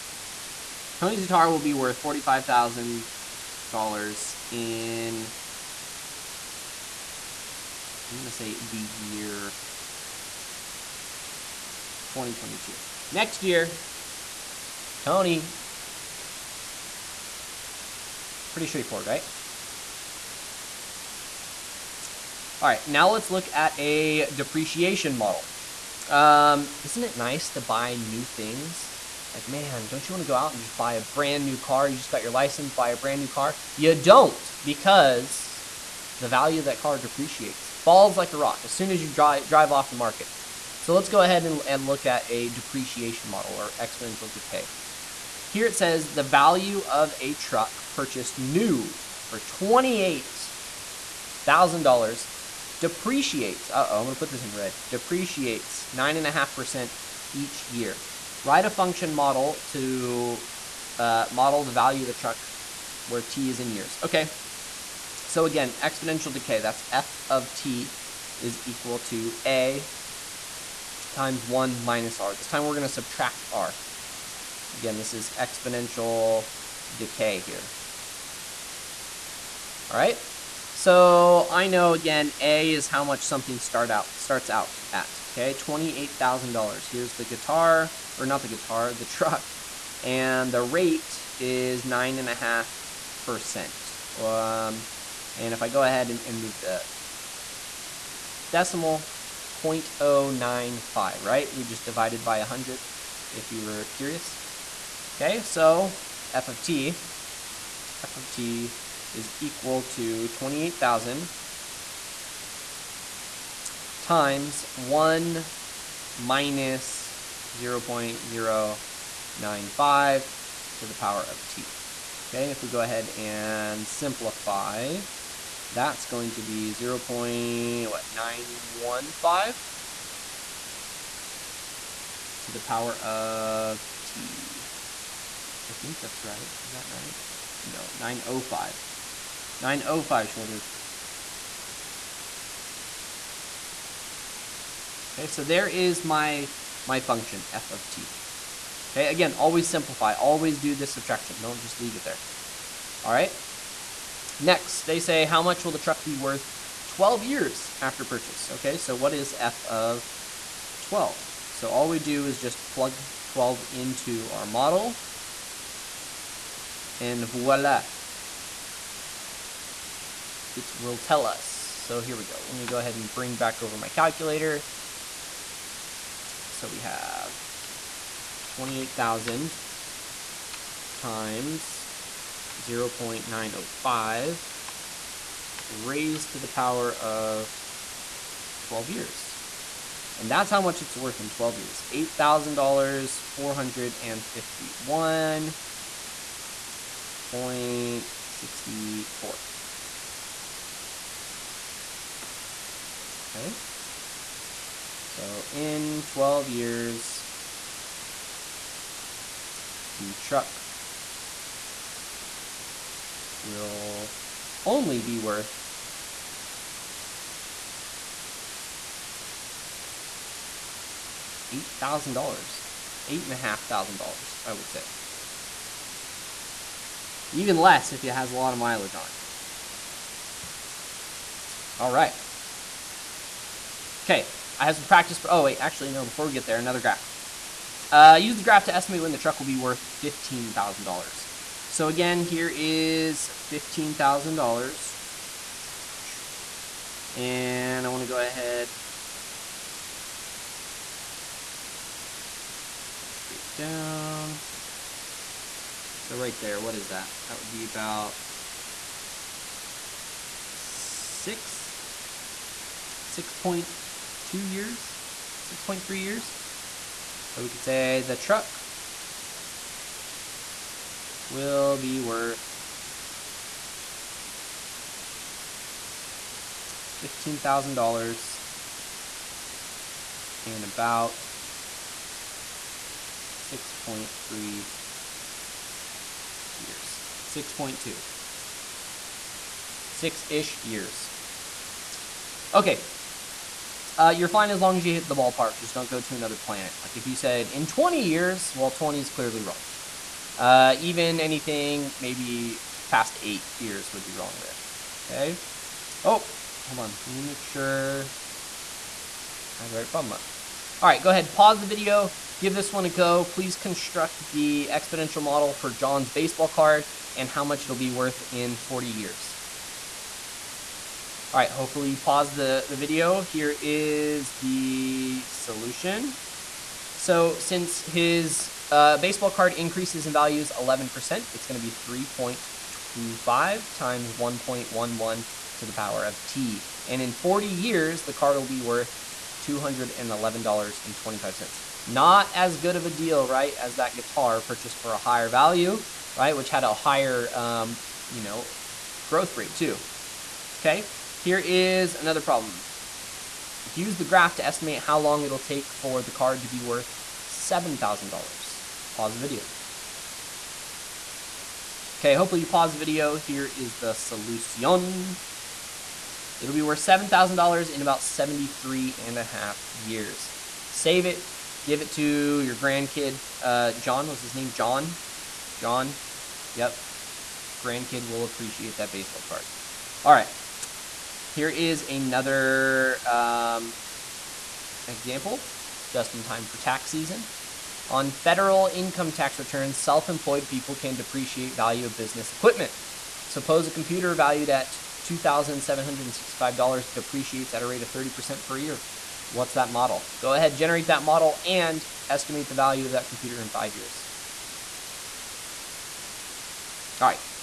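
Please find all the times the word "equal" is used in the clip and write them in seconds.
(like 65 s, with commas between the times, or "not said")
68 s, 109 s.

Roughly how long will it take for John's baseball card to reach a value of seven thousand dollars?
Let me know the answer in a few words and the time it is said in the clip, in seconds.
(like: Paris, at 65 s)
73.5 years, at 368 s.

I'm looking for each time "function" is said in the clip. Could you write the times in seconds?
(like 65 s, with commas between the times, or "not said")
58 s, 146 s.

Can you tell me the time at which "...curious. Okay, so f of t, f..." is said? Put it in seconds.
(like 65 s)
103 s.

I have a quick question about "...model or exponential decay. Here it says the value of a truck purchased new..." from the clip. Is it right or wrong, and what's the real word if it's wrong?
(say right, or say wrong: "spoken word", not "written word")
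right.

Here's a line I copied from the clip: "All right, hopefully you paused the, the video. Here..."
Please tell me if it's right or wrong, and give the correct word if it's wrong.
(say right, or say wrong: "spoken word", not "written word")
right.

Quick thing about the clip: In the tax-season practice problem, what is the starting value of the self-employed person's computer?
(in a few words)
$2,765.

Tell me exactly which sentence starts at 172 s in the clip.
Let me go ahead and bring back over my calculator.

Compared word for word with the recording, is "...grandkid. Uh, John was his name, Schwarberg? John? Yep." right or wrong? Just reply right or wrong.
wrong.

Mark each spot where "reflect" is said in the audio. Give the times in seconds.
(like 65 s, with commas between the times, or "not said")
not said.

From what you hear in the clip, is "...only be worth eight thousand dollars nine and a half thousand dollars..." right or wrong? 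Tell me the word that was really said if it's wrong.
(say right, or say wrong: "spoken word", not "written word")
wrong: "eight", not "nine".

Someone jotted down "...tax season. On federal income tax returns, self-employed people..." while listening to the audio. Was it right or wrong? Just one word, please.
right.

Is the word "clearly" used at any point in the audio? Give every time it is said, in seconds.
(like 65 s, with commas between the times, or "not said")
299 s.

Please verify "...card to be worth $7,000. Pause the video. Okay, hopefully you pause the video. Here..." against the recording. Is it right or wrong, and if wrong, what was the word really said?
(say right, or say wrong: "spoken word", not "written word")
right.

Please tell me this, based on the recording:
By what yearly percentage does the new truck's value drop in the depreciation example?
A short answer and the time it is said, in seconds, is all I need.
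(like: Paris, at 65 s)
9.5%, at 55 s.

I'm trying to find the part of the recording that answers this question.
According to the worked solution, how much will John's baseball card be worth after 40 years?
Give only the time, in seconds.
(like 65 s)
339 s.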